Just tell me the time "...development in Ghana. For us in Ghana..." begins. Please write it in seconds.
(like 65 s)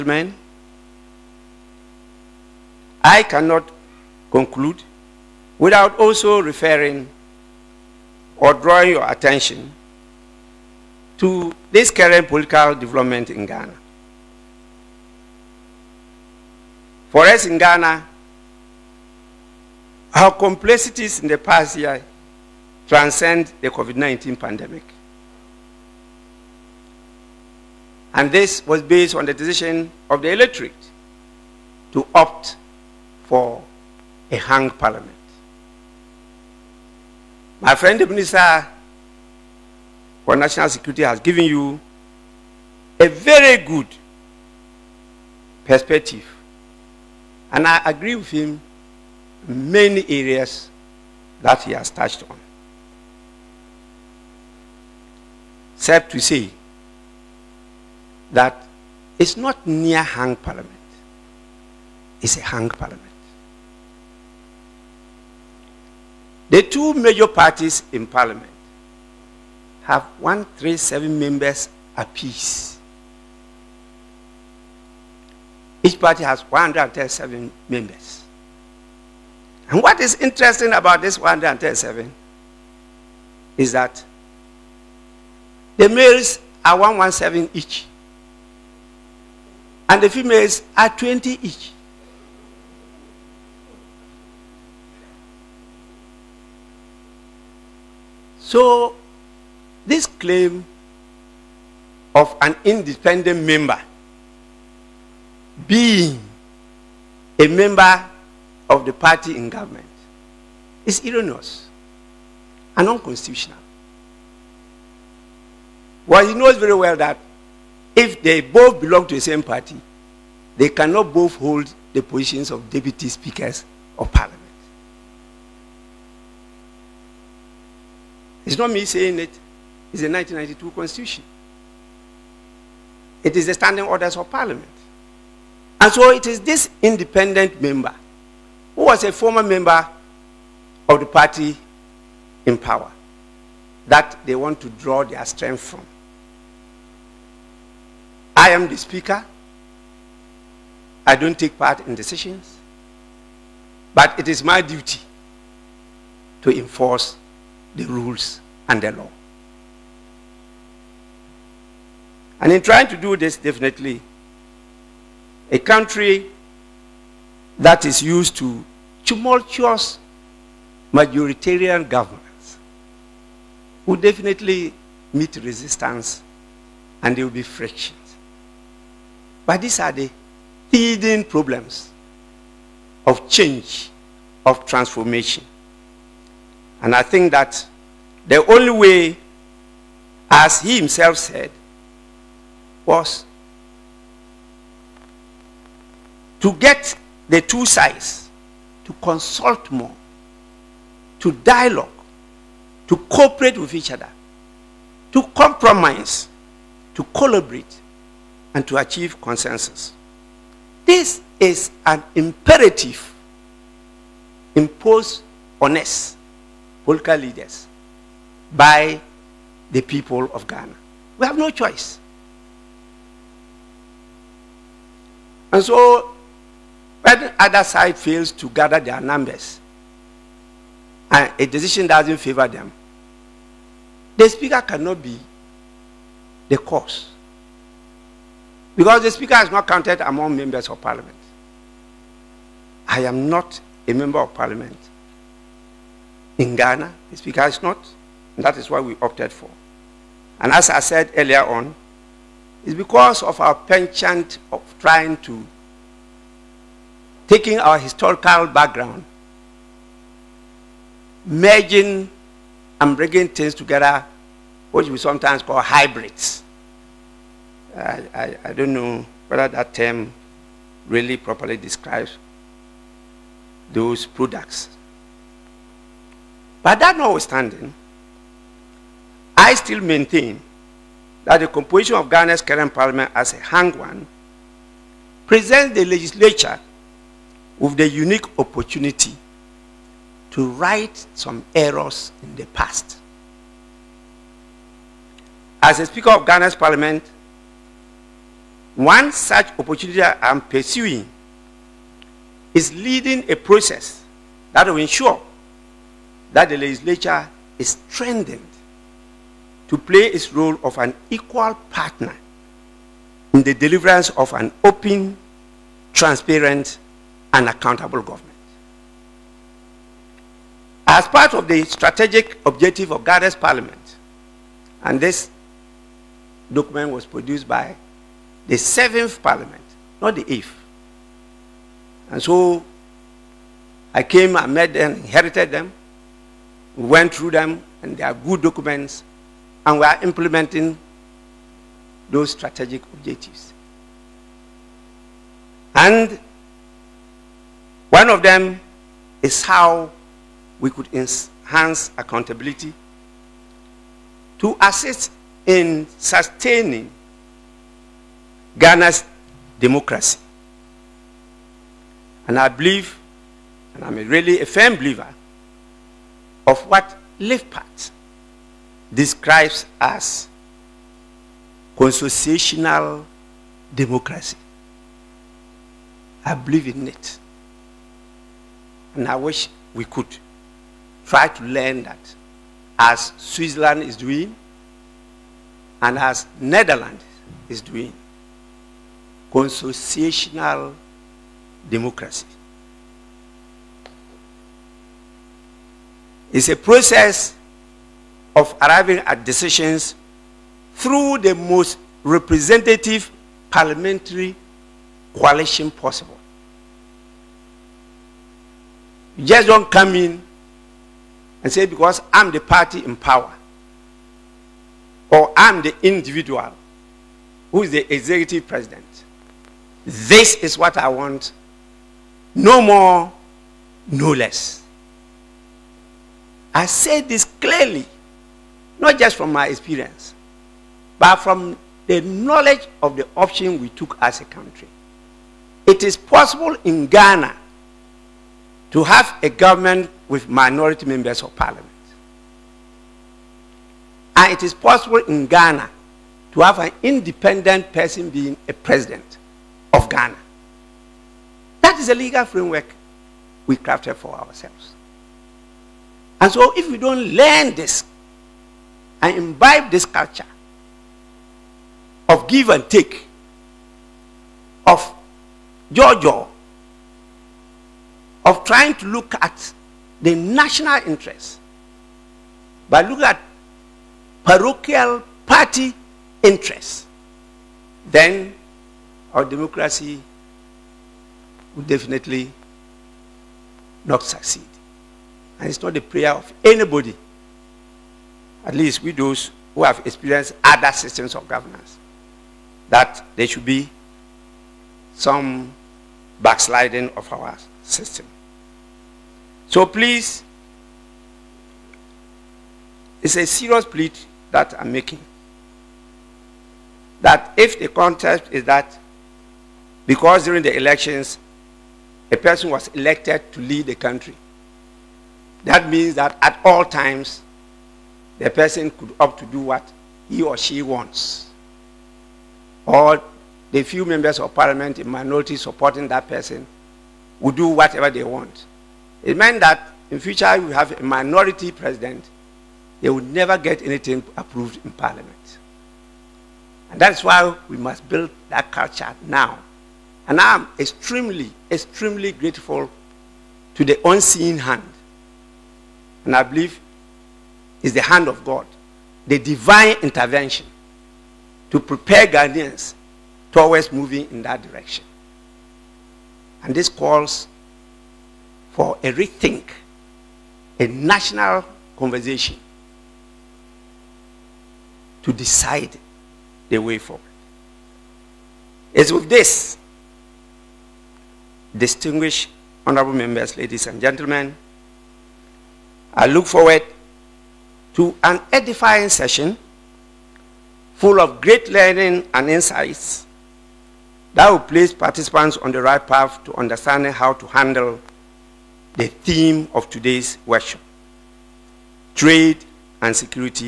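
12 s.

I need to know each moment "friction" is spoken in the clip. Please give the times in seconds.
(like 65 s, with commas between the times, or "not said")
177 s.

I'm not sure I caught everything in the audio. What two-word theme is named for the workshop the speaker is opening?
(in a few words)
Trade and security.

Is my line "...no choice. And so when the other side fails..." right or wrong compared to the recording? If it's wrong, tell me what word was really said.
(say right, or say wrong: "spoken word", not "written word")
right.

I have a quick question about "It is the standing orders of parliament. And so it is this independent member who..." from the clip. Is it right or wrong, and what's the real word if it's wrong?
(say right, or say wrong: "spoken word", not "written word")
right.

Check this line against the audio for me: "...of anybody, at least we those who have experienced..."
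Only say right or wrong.
right.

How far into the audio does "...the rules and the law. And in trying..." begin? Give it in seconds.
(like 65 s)
157 s.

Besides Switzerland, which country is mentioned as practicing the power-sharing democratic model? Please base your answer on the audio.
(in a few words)
Netherlands.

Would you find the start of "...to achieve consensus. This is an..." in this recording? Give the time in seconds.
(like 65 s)
208 s.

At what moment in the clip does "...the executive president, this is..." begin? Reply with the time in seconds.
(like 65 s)
417 s.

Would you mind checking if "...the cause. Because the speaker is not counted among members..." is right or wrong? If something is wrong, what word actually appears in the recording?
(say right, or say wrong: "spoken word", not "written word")
right.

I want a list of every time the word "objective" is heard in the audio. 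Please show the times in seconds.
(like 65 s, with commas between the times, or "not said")
322 s, 342 s.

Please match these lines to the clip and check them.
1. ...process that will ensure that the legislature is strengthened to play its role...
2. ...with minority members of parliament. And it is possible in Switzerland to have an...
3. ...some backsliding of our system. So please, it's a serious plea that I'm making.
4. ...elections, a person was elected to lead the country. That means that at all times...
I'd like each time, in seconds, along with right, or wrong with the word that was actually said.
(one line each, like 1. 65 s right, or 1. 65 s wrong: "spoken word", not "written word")
1. 303 s right
2. 440 s wrong: "Ghana", not "Switzerland"
3. 494 s right
4. 510 s right.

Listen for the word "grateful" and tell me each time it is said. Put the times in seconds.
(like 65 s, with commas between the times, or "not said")
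542 s.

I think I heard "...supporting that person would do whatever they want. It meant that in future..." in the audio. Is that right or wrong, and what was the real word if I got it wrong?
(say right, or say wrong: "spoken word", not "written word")
right.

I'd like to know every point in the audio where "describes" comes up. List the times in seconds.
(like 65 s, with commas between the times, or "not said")
271 s, 368 s.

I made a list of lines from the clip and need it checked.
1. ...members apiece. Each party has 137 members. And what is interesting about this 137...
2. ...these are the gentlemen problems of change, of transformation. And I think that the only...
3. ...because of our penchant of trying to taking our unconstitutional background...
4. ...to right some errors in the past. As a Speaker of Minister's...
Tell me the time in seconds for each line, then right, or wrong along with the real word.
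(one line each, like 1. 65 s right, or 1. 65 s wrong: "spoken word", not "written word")
1. 71 s right
2. 179 s wrong: "hidden", not "gentlemen"
3. 252 s wrong: "historical", not "unconstitutional"
4. 290 s wrong: "Ghana", not "Minister".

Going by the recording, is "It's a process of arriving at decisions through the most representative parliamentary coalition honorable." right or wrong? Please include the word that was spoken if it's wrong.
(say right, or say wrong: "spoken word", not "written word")
wrong: "possible", not "honorable".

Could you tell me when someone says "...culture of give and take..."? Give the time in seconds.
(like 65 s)
459 s.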